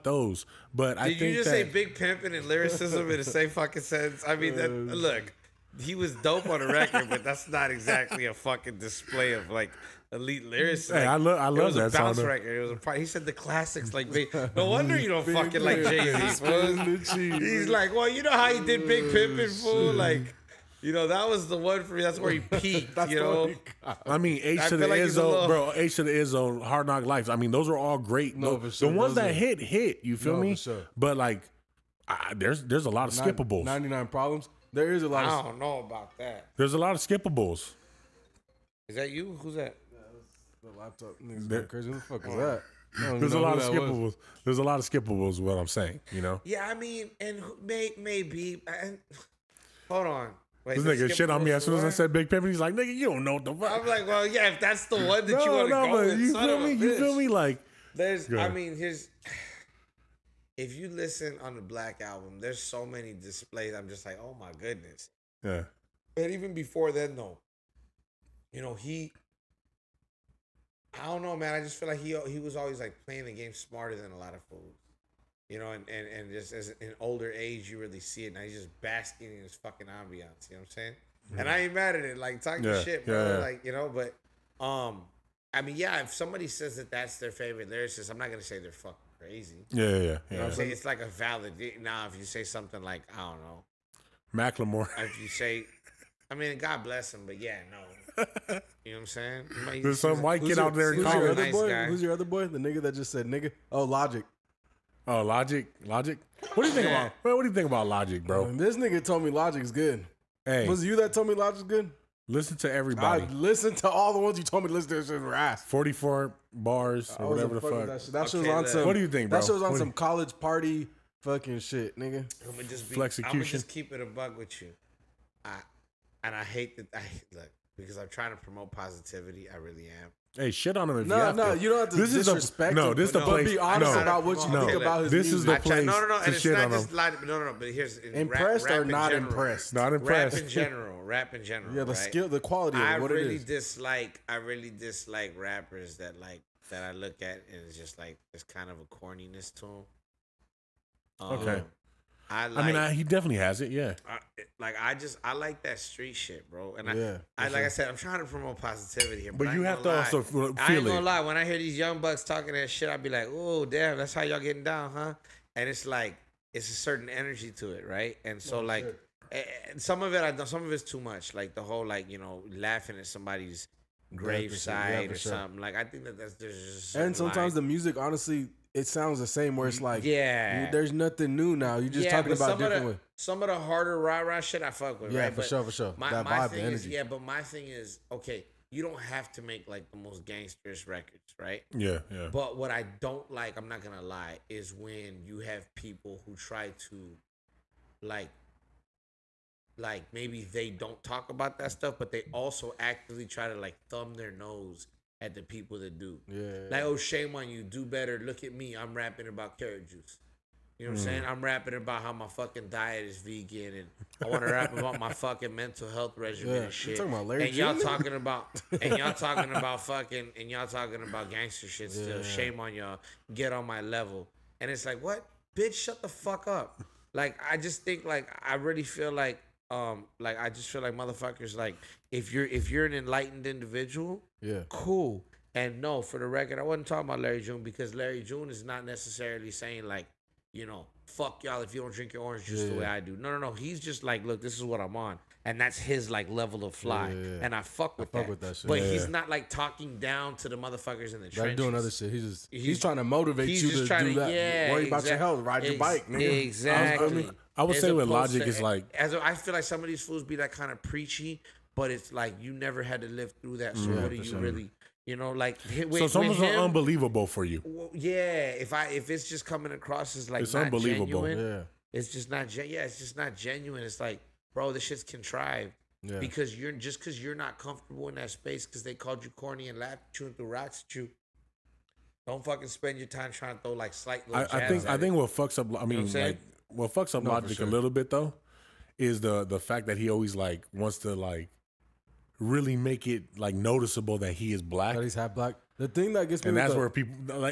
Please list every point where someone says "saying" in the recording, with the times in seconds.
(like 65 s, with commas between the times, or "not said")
45 s, 80 s, 90 s, 99 s, 211 s, 239 s.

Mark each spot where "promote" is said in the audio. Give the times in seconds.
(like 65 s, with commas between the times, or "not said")
128 s, 158 s.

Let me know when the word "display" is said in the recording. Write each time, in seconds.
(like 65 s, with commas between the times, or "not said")
8 s, 63 s.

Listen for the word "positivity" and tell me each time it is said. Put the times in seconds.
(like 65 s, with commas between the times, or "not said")
128 s, 158 s.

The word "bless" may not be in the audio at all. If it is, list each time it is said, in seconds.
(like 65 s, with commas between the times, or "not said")
96 s.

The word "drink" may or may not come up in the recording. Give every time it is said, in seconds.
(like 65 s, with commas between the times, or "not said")
241 s.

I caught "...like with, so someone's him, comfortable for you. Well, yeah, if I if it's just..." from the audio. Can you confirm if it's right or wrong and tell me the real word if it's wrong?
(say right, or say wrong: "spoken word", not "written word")
wrong: "unbelievable", not "comfortable".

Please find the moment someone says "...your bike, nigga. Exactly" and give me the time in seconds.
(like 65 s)
255 s.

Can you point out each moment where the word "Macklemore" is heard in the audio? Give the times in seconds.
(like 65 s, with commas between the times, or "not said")
94 s.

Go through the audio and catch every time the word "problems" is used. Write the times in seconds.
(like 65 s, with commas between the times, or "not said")
34 s.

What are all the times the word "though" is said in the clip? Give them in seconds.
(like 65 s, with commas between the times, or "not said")
67 s, 288 s.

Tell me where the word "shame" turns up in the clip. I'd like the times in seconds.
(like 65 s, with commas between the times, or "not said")
206 s, 222 s.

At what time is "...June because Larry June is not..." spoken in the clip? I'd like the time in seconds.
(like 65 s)
237 s.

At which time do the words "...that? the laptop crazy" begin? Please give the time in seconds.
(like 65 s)
39 s.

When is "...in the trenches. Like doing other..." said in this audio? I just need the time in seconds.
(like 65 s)
251 s.